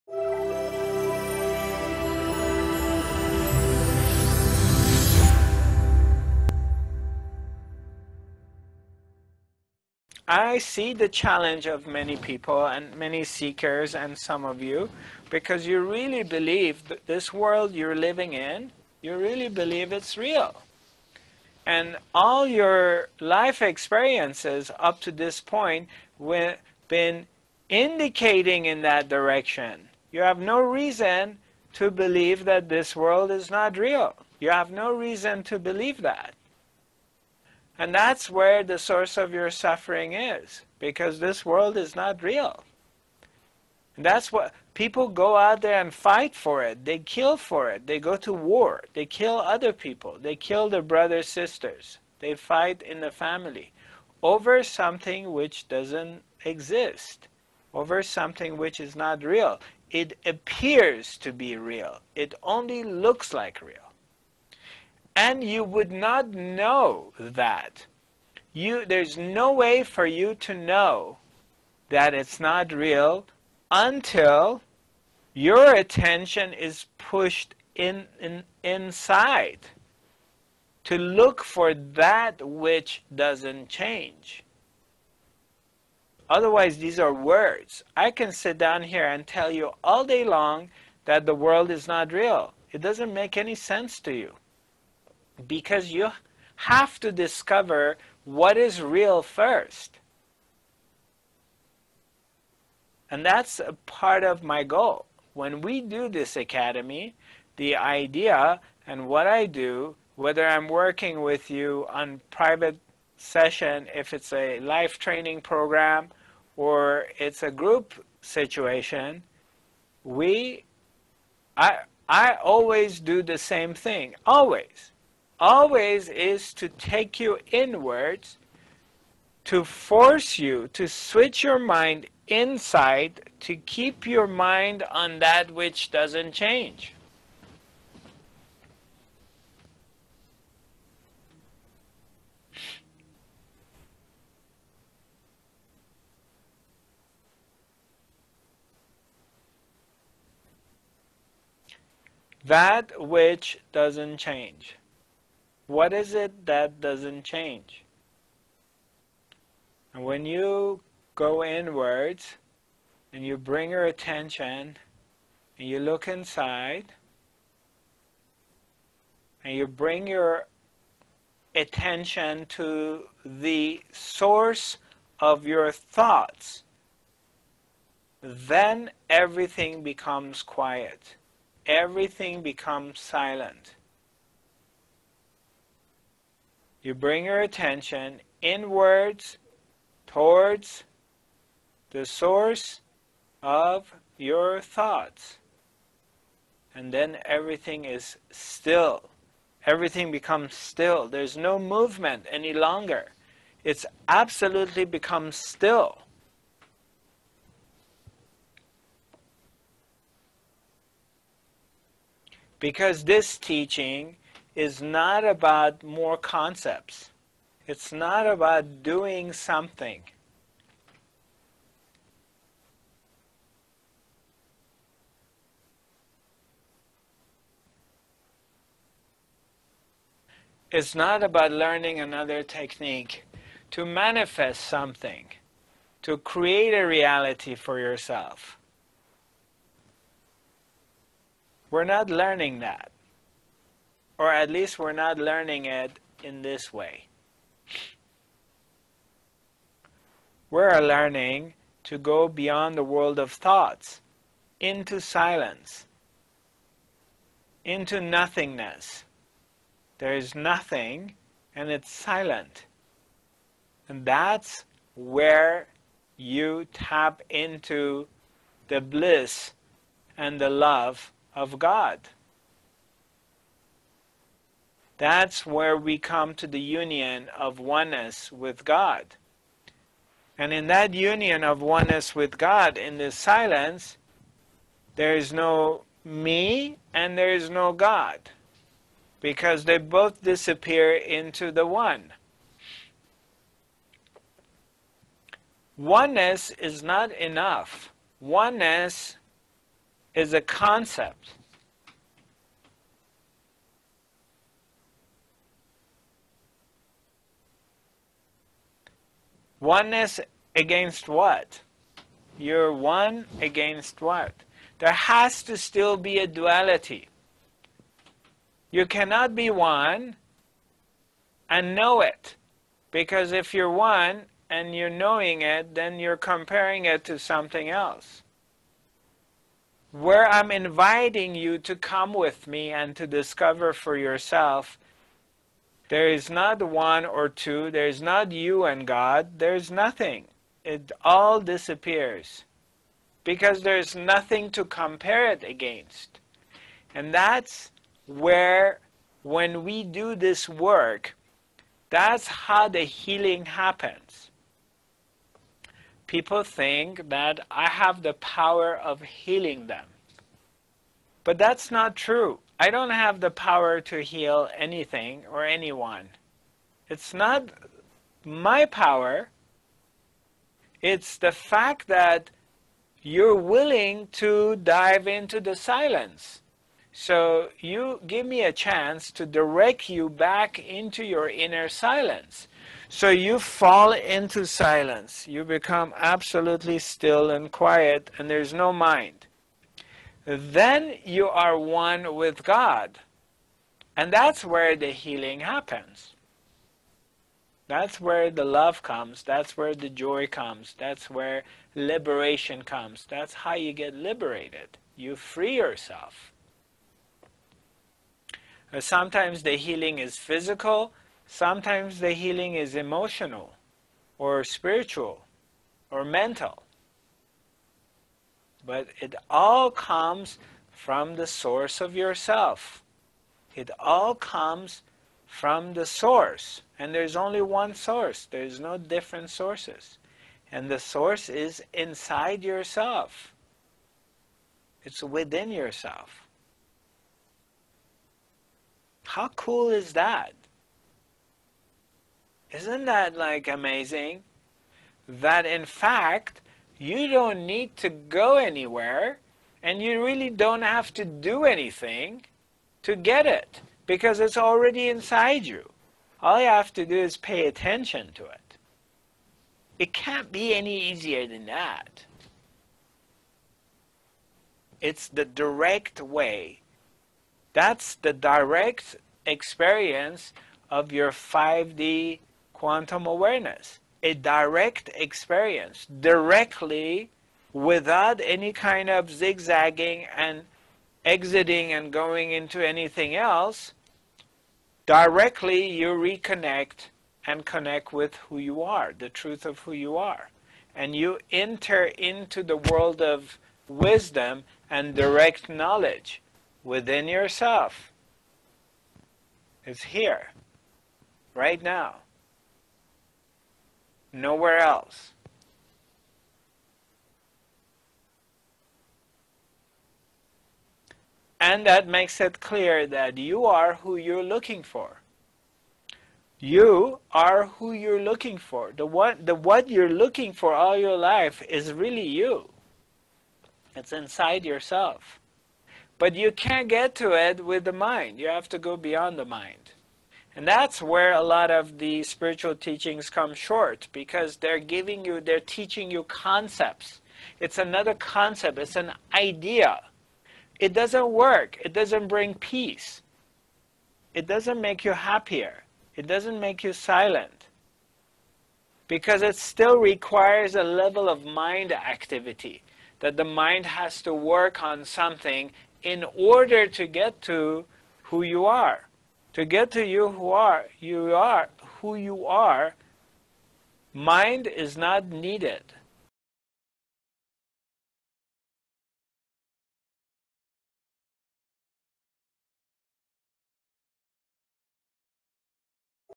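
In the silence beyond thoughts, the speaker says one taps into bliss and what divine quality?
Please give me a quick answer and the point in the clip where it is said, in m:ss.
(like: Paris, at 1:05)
the love of God, at 4:30.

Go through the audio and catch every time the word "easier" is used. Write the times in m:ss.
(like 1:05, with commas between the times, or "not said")
7:40.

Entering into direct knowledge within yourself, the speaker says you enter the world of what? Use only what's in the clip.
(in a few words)
wisdom.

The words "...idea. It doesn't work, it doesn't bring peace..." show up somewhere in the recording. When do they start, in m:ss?
8:59.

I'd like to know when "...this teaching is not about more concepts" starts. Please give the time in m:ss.
3:33.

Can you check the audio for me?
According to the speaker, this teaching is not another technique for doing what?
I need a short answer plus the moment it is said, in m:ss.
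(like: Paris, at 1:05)
manifest something, at 3:53.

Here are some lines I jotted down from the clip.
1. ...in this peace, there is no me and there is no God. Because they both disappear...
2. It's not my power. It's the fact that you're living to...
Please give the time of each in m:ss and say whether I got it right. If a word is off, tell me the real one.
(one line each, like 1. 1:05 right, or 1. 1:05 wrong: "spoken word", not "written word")
1. 4:42 wrong: "silence", not "peace"
2. 6:06 wrong: "willing", not "living".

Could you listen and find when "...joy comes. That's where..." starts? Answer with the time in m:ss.
6:39.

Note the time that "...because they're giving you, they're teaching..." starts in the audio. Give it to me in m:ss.
8:53.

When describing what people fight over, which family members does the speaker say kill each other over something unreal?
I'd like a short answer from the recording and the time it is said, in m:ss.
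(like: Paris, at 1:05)
brothers, sisters, at 0:50.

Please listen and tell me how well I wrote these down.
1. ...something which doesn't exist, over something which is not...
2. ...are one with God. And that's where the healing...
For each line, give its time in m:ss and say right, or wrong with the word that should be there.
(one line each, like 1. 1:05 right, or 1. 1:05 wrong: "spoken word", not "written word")
1. 0:54 right
2. 6:31 right.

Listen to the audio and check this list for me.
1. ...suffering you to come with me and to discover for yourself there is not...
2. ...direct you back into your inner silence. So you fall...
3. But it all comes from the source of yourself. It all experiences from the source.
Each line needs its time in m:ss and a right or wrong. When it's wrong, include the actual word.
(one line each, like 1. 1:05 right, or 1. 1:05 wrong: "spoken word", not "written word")
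1. 5:30 wrong: "inviting", not "suffering"
2. 6:19 right
3. 6:58 wrong: "comes", not "experiences".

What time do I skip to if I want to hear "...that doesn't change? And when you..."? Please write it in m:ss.
2:36.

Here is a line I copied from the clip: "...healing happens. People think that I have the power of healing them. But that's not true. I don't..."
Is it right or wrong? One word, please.
right.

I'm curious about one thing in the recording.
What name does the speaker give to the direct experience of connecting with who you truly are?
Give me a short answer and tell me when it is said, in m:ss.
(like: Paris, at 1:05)
5D quantum awareness, at 7:51.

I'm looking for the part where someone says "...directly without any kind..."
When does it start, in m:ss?
7:55.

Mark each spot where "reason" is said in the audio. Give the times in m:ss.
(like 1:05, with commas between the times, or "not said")
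0:30, 0:34.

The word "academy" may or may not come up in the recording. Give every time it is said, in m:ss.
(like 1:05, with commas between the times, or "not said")
1:46.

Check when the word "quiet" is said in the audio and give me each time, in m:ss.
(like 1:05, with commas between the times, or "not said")
3:00, 6:27.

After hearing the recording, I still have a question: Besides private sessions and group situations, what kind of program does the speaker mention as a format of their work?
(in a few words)
life training program.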